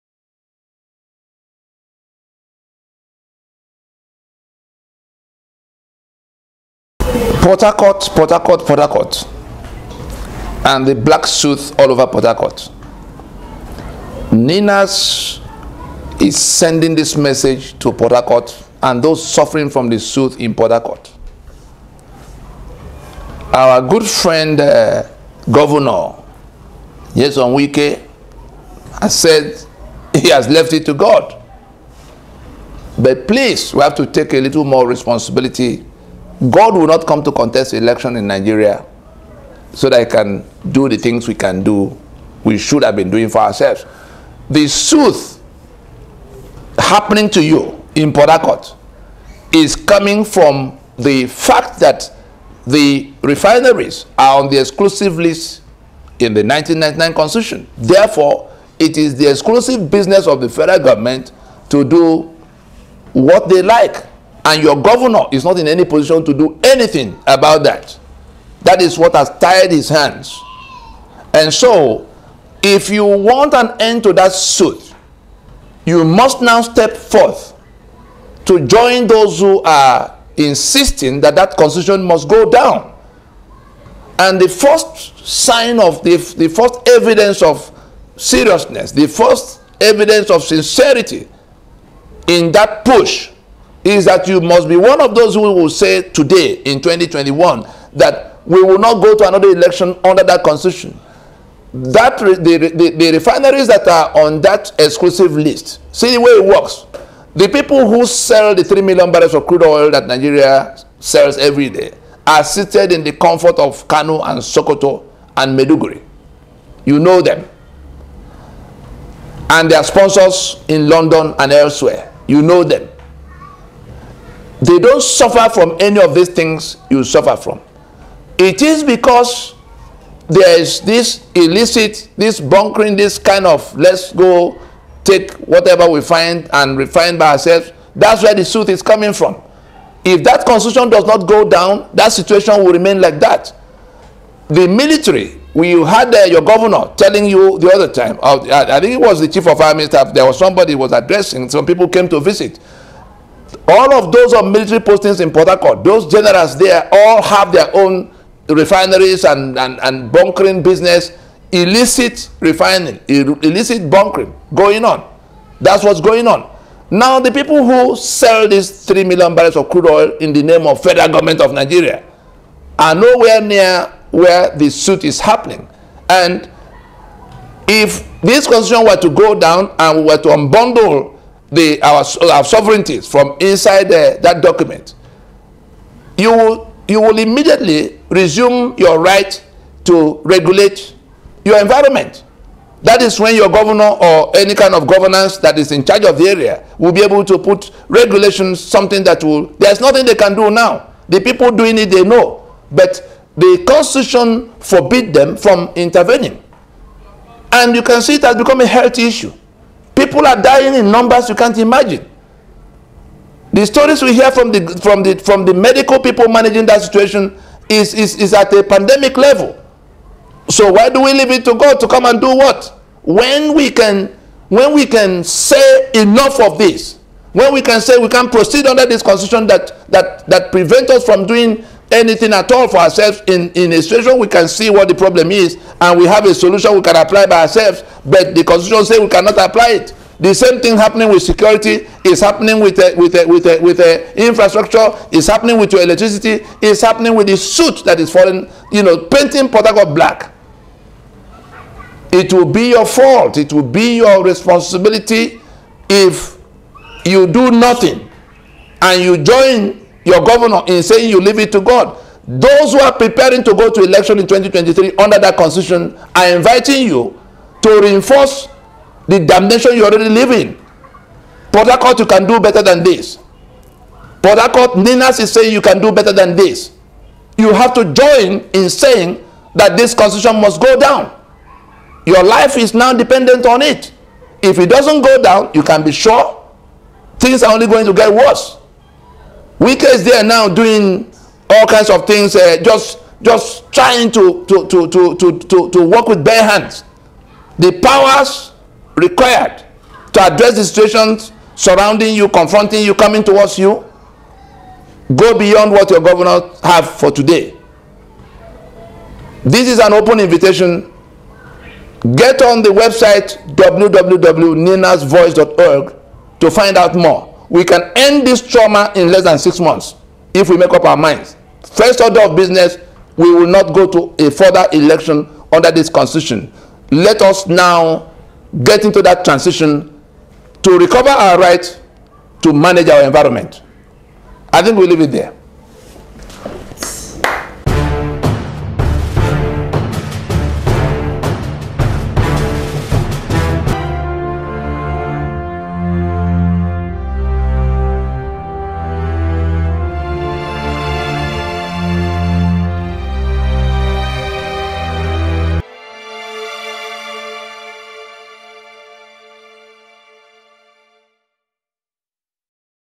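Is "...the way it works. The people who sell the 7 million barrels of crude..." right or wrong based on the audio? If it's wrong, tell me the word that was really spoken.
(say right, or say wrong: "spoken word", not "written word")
wrong: "3", not "7".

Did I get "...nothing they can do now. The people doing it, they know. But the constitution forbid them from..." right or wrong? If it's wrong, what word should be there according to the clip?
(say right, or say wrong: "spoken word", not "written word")
right.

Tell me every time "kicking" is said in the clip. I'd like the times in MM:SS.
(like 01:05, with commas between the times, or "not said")
not said.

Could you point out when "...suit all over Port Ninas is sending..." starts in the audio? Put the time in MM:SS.
00:11.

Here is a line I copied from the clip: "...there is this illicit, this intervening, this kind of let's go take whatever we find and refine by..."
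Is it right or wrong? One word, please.
wrong.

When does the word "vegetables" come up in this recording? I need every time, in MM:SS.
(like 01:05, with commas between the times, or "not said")
not said.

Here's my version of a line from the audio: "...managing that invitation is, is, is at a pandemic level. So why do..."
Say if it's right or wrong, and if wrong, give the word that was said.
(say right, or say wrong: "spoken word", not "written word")
wrong: "situation", not "invitation".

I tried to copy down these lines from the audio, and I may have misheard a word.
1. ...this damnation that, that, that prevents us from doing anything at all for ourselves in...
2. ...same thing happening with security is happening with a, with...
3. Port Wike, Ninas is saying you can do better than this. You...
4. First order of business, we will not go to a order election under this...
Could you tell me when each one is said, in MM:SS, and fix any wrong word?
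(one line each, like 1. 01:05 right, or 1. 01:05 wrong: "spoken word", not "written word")
1. 03:48 wrong: "constitution", not "damnation"
2. 04:00 right
3. 04:34 wrong: "Harcourt", not "Wike"
4. 05:21 wrong: "further", not "order".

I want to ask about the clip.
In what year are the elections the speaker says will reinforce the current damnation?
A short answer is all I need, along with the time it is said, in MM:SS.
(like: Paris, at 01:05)
2023, at 04:24.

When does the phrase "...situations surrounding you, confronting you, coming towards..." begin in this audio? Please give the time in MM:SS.
05:00.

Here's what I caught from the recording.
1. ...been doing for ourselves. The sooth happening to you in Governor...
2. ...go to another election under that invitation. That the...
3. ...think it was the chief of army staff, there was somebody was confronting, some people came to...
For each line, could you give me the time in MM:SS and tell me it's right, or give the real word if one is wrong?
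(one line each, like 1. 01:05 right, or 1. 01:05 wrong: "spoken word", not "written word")
1. 00:42 wrong: "Port", not "Governor"
2. 01:39 wrong: "constitution", not "invitation"
3. 02:28 wrong: "addressing", not "confronting".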